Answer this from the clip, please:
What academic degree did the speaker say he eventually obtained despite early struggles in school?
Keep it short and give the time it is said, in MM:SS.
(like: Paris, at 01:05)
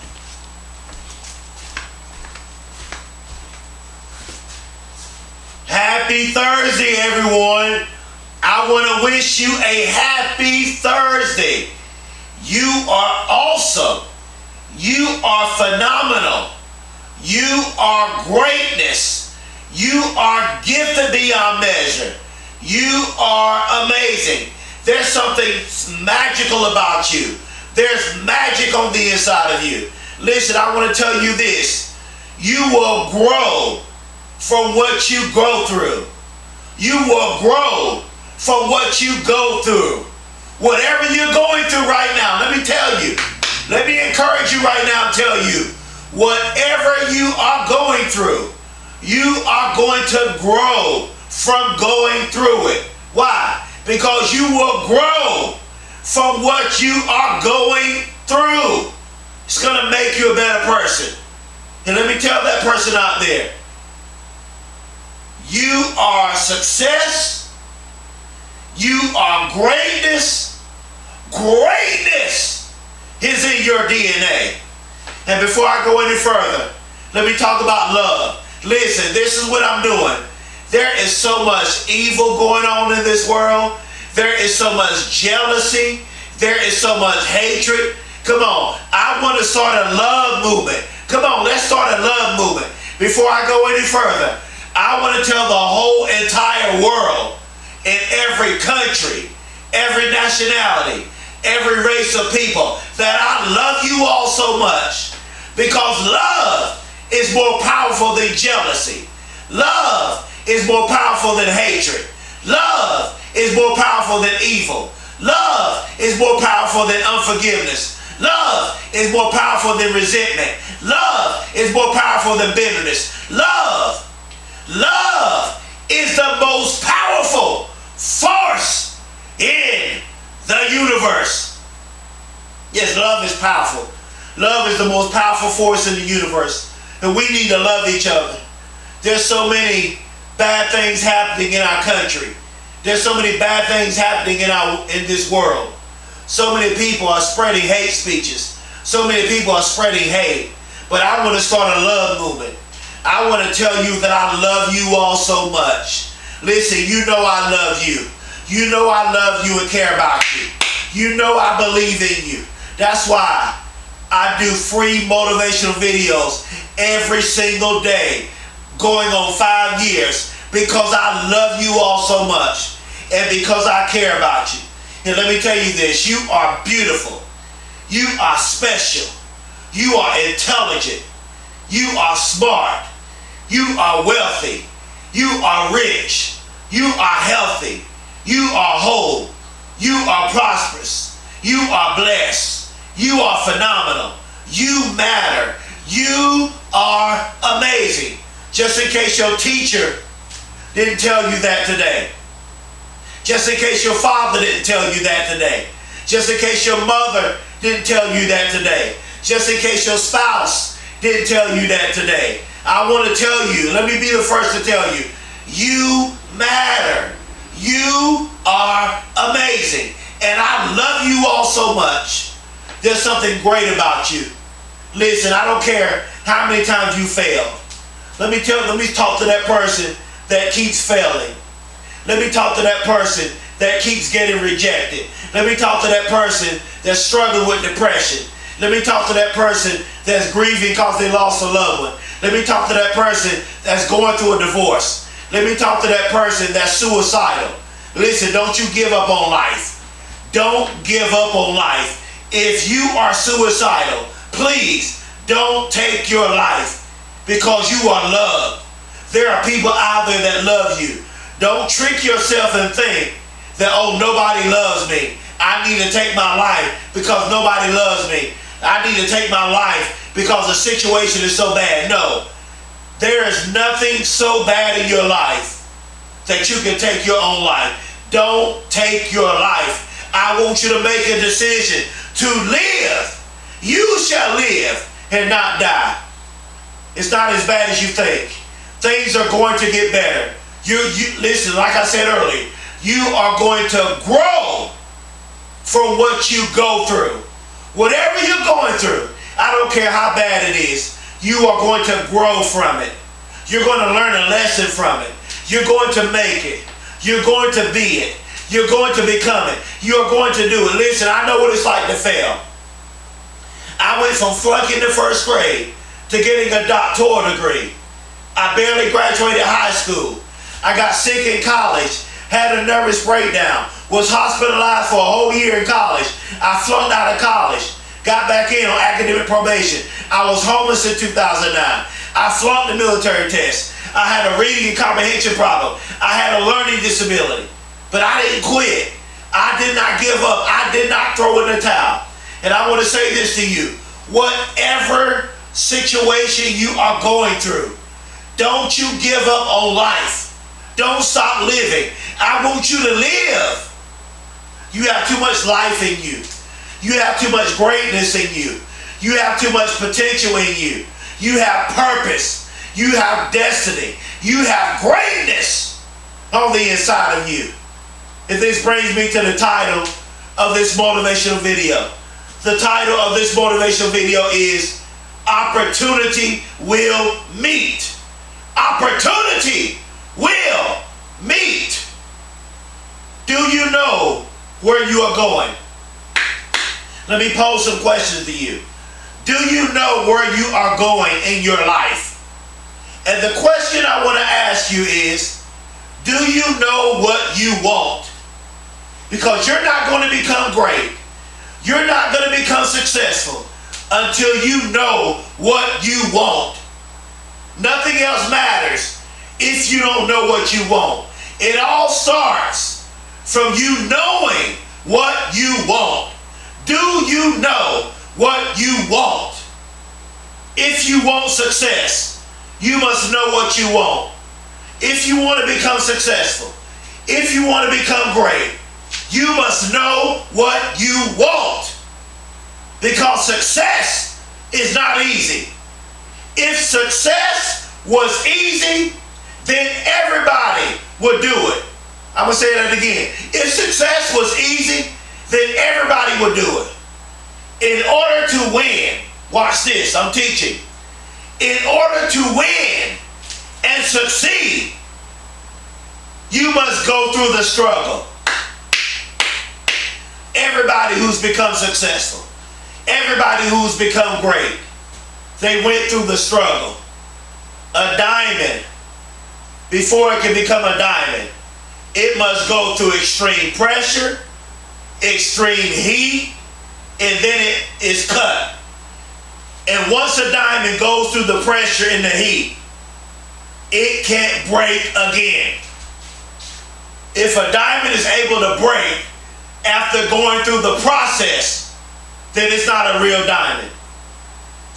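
doctoral degree, at 05:16.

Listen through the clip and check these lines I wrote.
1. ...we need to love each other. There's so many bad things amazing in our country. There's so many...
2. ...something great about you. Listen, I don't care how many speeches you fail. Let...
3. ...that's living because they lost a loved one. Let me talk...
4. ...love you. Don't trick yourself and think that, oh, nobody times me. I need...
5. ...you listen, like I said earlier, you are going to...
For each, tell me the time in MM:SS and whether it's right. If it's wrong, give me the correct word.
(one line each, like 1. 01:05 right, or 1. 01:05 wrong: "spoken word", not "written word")
1. 02:17 wrong: "happening", not "amazing"
2. 03:43 wrong: "times", not "speeches"
3. 04:00 wrong: "grieving", not "living"
4. 04:20 wrong: "loves", not "times"
5. 04:50 right.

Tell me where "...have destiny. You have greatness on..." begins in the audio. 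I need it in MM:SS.
06:02.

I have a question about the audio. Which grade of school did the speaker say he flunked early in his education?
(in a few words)
first grade.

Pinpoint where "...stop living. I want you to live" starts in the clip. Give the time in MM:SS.
05:51.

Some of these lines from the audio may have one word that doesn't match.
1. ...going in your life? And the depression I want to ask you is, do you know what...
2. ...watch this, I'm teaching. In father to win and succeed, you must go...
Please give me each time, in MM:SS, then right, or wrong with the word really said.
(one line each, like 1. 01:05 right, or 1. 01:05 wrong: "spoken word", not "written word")
1. 06:30 wrong: "question", not "depression"
2. 07:29 wrong: "order", not "father".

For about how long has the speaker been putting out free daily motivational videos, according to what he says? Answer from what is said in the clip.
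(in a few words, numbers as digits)
5 years.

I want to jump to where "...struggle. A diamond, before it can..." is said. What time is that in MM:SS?
07:46.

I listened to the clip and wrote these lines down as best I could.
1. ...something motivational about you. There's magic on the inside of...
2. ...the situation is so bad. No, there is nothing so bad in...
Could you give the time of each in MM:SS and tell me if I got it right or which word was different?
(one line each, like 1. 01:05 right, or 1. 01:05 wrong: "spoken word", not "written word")
1. 00:25 wrong: "magical", not "motivational"
2. 04:30 right.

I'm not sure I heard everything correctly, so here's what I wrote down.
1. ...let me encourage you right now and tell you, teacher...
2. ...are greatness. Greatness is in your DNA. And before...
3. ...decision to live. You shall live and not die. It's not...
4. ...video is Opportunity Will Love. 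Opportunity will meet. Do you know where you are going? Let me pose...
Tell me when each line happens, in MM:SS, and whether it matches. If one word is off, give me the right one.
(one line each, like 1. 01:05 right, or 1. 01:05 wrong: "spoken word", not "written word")
1. 00:43 wrong: "whatever", not "teacher"
2. 01:09 right
3. 04:41 right
4. 06:13 wrong: "Meet", not "Love".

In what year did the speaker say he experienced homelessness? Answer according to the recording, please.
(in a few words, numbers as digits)
2009.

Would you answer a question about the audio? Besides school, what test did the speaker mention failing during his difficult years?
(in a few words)
military test.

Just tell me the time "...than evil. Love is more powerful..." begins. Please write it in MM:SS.
01:54.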